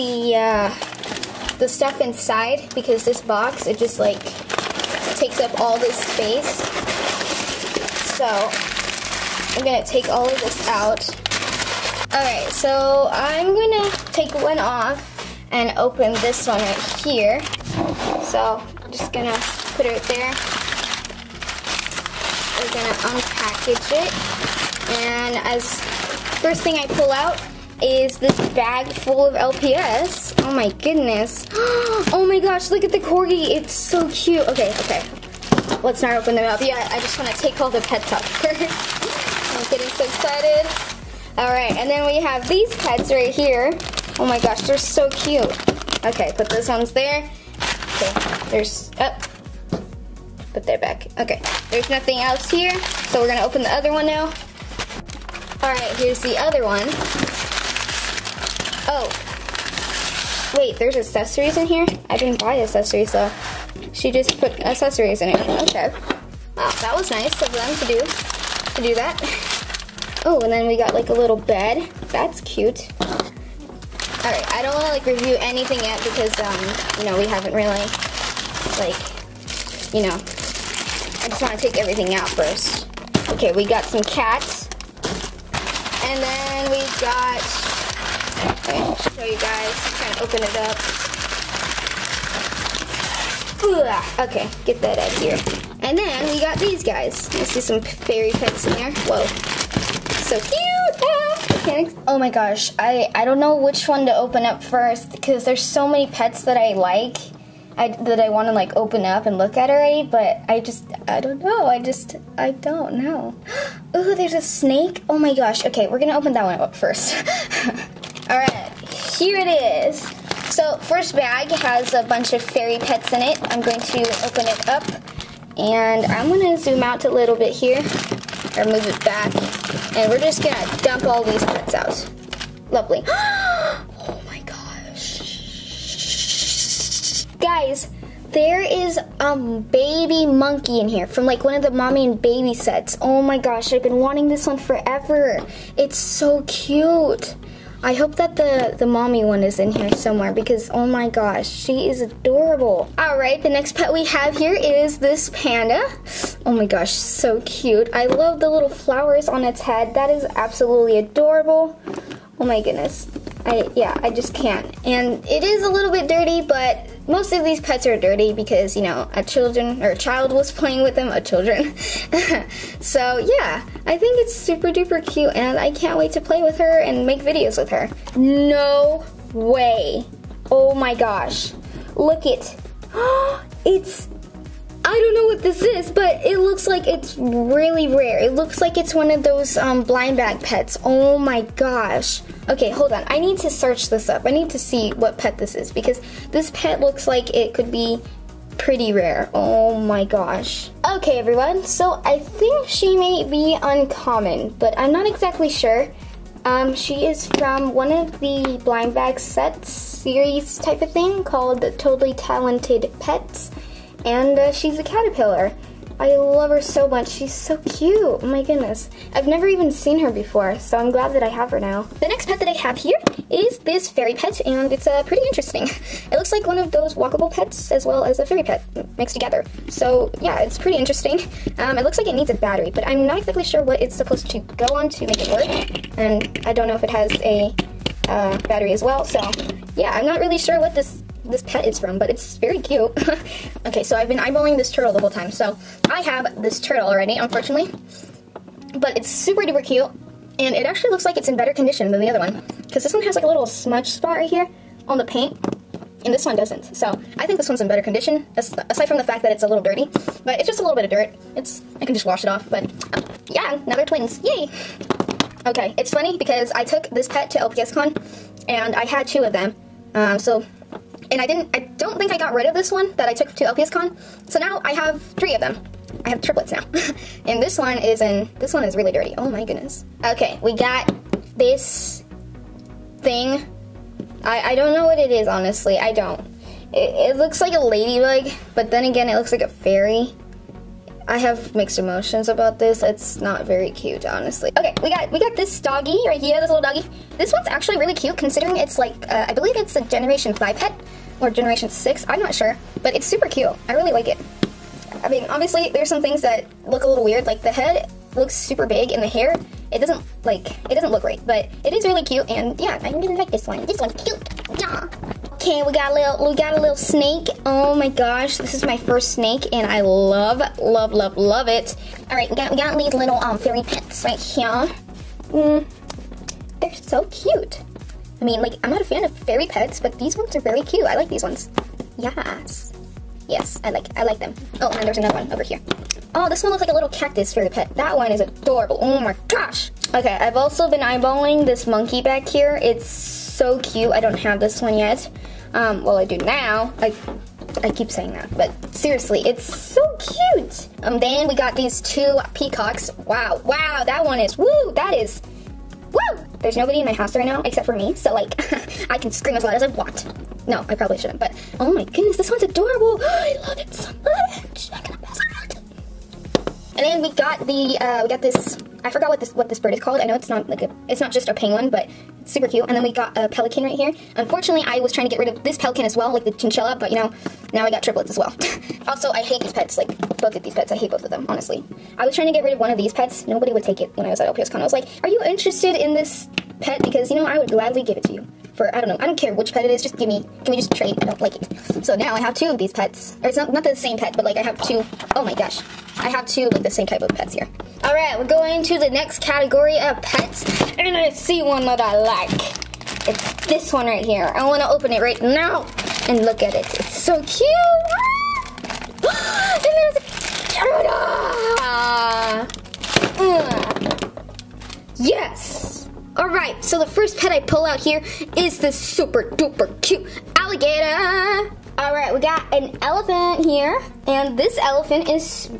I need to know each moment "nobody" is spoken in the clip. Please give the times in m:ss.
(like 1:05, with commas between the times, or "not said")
5:56, 6:23.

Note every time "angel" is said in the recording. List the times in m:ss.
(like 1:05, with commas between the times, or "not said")
not said.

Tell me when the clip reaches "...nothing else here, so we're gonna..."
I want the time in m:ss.
0:51.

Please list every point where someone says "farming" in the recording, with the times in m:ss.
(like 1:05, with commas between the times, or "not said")
not said.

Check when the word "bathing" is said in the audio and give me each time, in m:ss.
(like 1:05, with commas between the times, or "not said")
not said.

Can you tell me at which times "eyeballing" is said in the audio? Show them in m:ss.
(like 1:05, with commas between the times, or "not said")
4:04, 5:40.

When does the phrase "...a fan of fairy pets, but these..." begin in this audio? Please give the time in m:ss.
5:28.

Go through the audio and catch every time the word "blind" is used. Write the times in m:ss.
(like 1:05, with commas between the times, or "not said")
3:09, 3:28.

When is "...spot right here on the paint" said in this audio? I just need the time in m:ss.
4:13.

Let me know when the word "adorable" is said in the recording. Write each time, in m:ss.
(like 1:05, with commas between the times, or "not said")
2:32, 2:40, 5:38, 6:02.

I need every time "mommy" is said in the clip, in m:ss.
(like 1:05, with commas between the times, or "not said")
2:21, 2:28.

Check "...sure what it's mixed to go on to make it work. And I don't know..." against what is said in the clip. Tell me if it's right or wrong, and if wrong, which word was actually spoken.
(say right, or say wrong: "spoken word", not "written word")
wrong: "supposed", not "mixed".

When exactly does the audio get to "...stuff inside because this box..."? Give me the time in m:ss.
0:01.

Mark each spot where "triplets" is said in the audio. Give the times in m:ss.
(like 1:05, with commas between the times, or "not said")
4:36, 6:17.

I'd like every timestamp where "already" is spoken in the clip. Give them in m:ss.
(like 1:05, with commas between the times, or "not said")
1:49, 4:06.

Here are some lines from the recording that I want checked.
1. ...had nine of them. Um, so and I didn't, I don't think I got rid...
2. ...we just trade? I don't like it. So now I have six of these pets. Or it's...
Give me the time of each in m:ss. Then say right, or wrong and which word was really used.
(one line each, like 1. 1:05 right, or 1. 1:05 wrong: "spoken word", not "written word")
1. 4:28 wrong: "two", not "nine"
2. 6:30 wrong: "two", not "six".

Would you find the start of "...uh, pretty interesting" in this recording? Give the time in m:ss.
3:44.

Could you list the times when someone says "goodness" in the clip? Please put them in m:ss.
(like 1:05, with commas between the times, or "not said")
0:30, 2:42, 3:38, 4:39, 6:01.